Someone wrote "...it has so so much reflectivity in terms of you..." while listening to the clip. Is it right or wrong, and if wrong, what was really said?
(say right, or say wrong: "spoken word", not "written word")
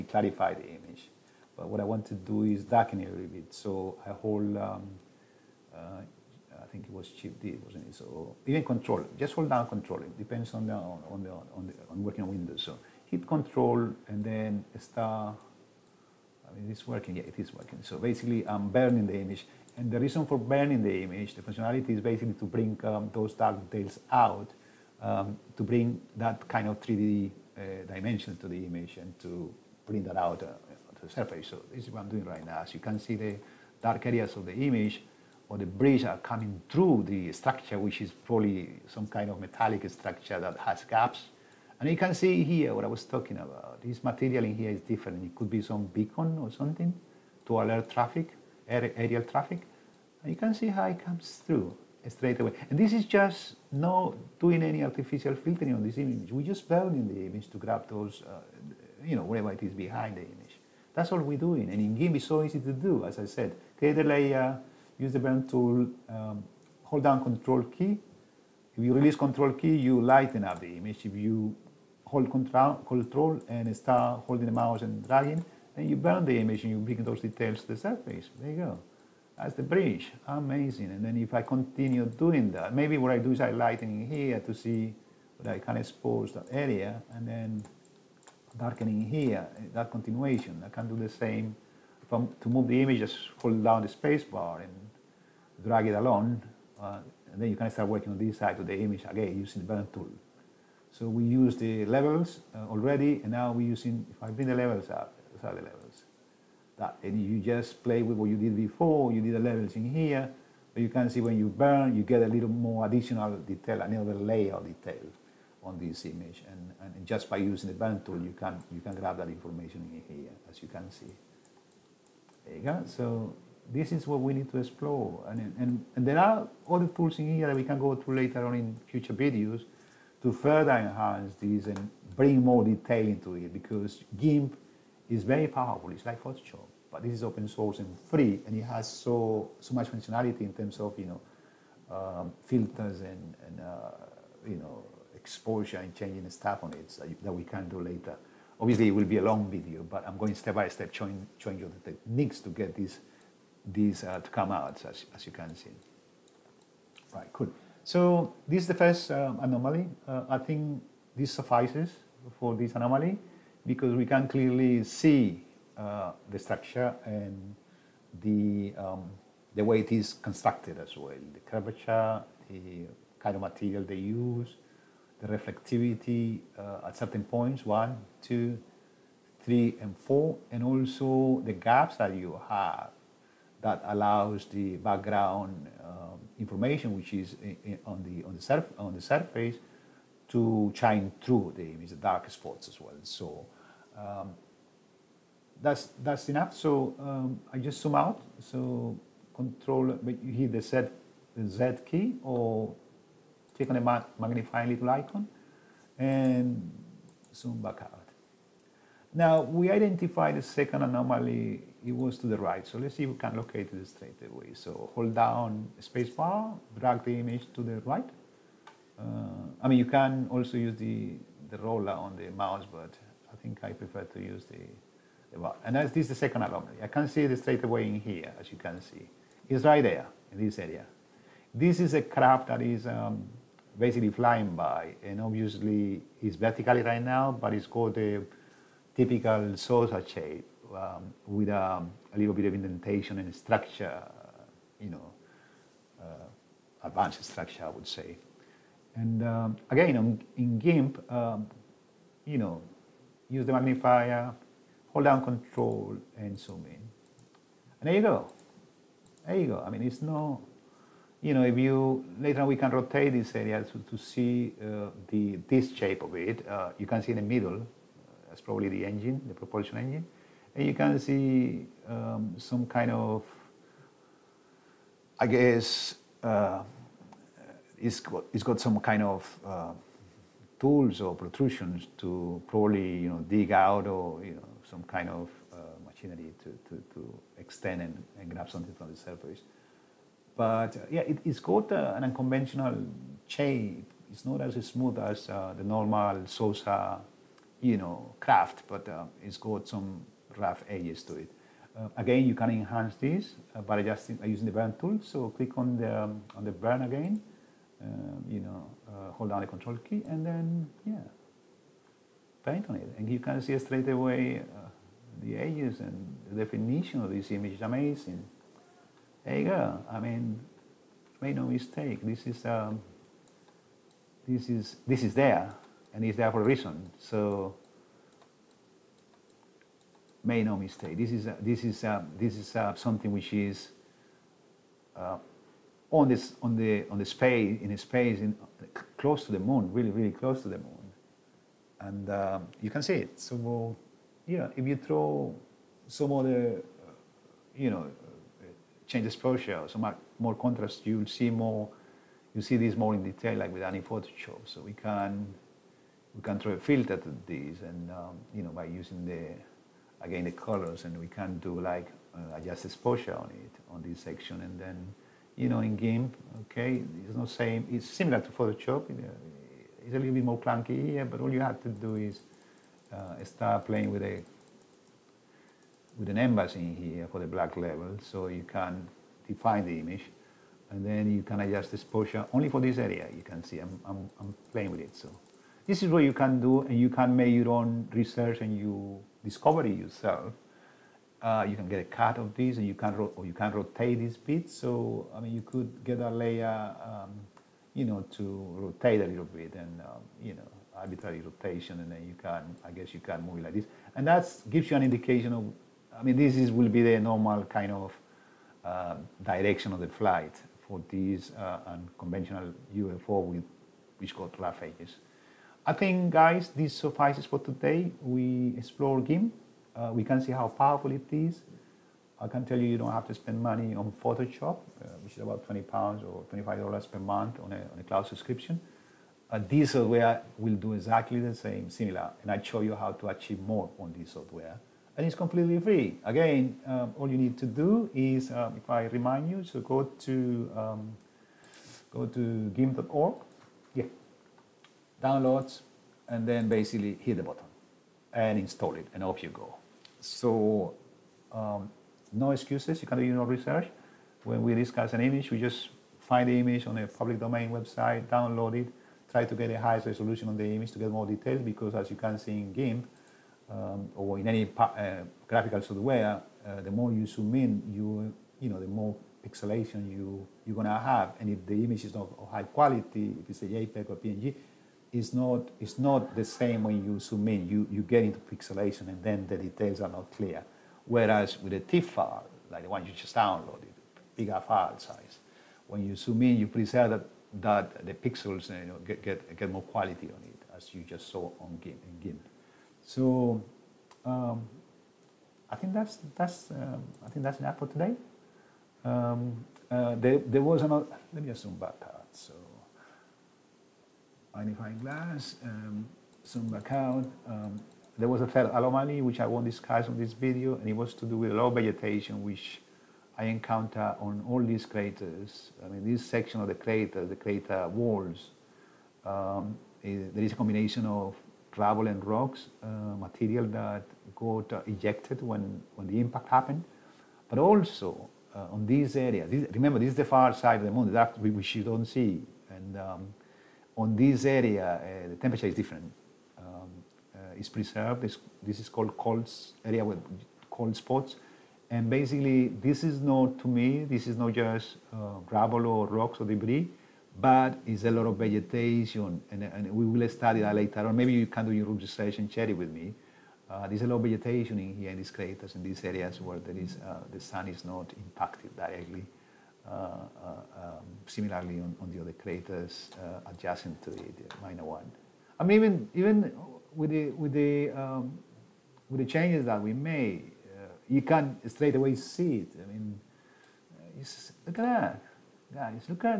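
wrong: "functionality", not "reflectivity".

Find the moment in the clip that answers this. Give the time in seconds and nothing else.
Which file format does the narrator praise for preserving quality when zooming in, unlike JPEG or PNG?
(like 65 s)
481 s.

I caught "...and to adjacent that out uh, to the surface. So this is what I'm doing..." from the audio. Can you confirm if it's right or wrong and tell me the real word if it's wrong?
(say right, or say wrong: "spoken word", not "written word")
wrong: "print", not "adjacent".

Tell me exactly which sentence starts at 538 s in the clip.
This, this is called cold area with cold spots.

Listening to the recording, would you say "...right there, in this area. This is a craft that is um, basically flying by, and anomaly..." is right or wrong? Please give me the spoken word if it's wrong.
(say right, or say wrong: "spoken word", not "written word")
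wrong: "obviously", not "anomaly".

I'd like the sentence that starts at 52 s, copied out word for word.
And this is just no doing any artificial filtering on this image.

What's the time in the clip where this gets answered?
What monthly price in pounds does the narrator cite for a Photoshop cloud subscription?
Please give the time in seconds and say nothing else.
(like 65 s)
425 s.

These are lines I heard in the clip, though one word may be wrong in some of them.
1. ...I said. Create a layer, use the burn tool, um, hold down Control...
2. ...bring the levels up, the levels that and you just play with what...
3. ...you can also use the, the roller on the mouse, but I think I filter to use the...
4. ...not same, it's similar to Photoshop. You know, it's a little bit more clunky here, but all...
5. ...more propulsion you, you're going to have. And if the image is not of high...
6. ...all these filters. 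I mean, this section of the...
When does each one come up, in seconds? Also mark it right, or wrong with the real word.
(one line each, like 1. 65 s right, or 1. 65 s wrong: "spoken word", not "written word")
1. 63 s right
2. 104 s right
3. 219 s wrong: "prefer", not "filter"
4. 367 s right
5. 468 s wrong: "pixelation", not "propulsion"
6. 514 s wrong: "craters", not "filters".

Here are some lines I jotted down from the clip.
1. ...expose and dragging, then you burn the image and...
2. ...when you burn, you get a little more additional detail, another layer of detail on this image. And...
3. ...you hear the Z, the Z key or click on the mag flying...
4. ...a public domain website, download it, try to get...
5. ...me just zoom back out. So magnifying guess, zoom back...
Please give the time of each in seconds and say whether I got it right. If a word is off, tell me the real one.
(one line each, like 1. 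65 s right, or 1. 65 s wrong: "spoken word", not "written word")
1. 74 s wrong: "mouse", not "expose"
2. 111 s right
3. 200 s wrong: "magnifying", not "flying"
4. 456 s right
5. 501 s wrong: "glass", not "guess".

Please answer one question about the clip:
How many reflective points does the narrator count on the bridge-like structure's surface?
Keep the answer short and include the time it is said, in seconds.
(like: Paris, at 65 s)
4, at 179 s.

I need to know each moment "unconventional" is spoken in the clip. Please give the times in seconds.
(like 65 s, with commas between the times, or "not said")
292 s, 411 s.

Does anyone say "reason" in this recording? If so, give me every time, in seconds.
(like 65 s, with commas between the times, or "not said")
19 s, 326 s.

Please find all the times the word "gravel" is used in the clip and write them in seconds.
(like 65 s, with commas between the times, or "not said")
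521 s, 545 s.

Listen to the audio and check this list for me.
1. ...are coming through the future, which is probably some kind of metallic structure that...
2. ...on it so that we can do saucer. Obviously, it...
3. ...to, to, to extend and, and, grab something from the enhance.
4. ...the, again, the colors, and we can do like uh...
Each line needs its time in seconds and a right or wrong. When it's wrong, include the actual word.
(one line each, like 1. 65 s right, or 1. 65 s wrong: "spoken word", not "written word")
1. 36 s wrong: "structure", not "future"
2. 146 s wrong: "later", not "saucer"
3. 286 s wrong: "surface", not "enhance"
4. 359 s right.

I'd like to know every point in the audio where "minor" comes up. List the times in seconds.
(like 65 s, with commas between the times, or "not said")
564 s.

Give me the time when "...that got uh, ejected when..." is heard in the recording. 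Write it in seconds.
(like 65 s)
523 s.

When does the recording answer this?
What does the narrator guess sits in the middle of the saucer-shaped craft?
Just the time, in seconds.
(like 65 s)
269 s.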